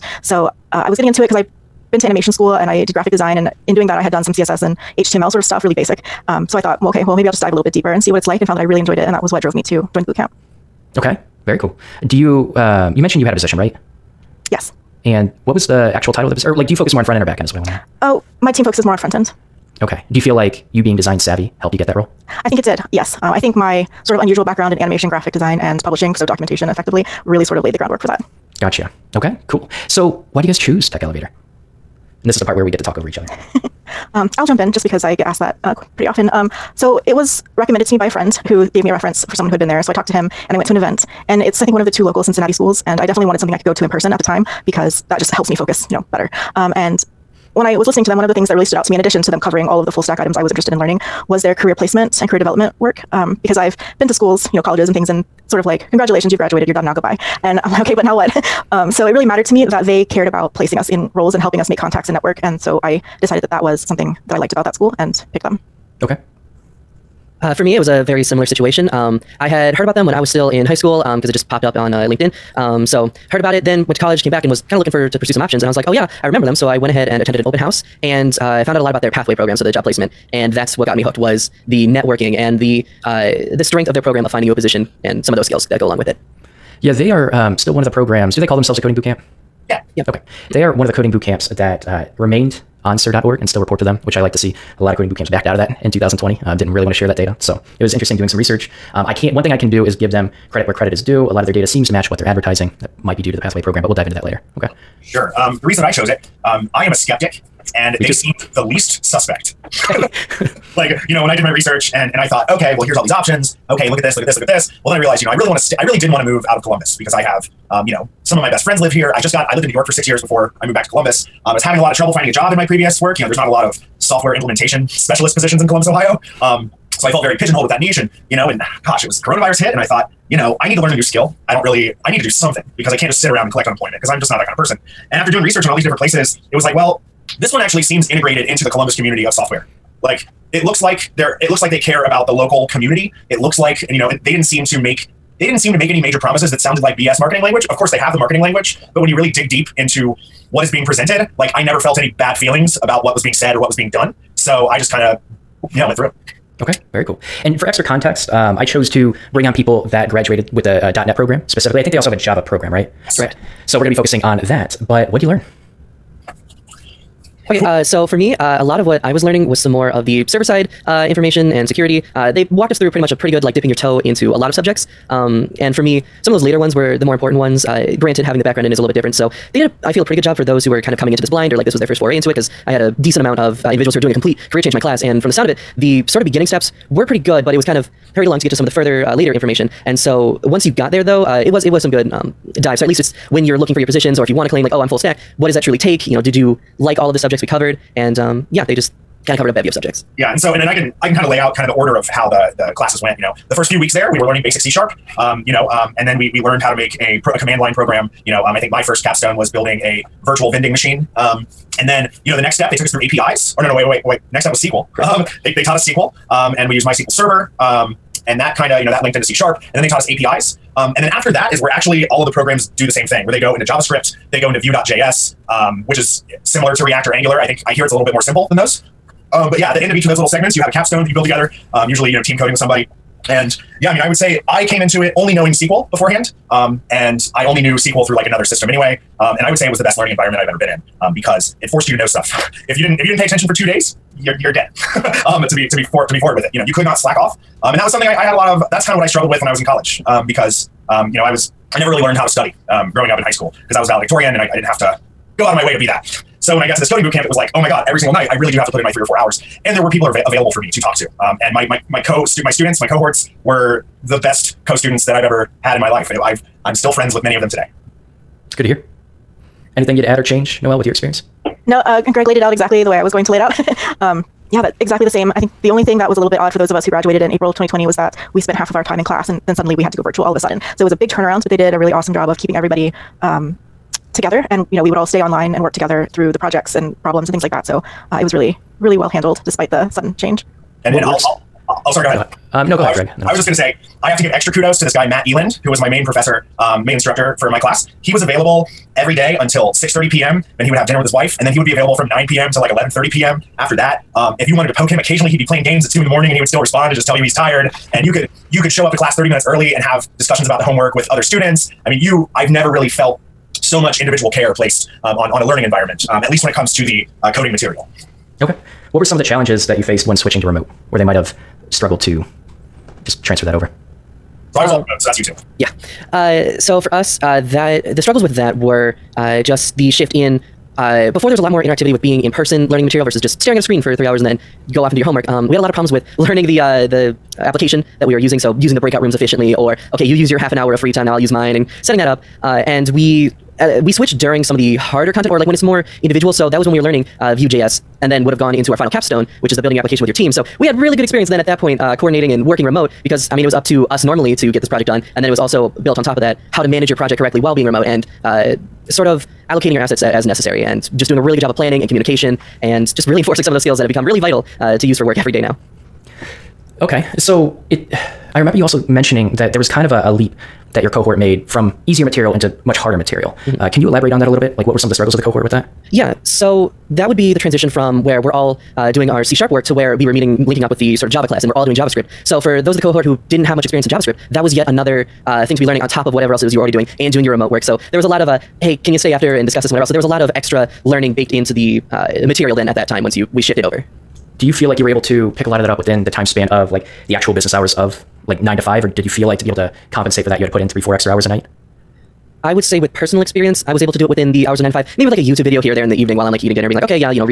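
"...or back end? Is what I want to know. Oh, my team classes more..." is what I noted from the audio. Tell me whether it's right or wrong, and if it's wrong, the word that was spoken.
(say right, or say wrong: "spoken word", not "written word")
wrong: "focuses", not "classes".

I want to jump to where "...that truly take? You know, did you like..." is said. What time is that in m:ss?
3:15.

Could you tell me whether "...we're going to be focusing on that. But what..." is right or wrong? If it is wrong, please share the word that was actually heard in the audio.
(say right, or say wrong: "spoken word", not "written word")
right.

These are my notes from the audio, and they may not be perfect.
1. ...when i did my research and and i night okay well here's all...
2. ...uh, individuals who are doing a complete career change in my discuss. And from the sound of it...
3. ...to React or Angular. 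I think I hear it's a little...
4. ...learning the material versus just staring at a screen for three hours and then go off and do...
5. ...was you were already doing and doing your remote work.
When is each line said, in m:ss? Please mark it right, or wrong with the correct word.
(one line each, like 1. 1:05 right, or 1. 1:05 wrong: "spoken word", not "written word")
1. 1:51 wrong: "thought", not "night"
2. 3:03 wrong: "class", not "discuss"
3. 3:46 right
4. 5:32 right
5. 6:26 right.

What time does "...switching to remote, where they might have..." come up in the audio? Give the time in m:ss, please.
5:20.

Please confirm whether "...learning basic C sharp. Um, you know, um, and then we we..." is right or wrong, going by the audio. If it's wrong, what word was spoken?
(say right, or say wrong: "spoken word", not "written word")
right.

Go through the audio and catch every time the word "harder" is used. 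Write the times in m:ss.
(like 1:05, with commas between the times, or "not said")
5:44, 6:12.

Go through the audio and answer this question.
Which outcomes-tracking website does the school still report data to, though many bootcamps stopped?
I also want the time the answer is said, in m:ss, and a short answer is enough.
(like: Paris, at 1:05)
CIRR.org, at 1:32.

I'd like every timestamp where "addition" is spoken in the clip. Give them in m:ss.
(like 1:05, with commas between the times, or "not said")
0:48.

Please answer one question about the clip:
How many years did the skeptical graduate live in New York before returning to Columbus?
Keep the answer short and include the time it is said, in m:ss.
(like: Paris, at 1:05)
6, at 1:59.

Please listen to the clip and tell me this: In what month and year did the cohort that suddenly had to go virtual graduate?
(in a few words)
April 2020.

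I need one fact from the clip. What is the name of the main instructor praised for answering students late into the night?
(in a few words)
Matt Eland.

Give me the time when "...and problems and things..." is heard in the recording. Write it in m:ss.
4:46.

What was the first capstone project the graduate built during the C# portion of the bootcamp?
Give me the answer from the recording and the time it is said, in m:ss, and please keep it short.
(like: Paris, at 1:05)
Virtual vending machine, at 3:30.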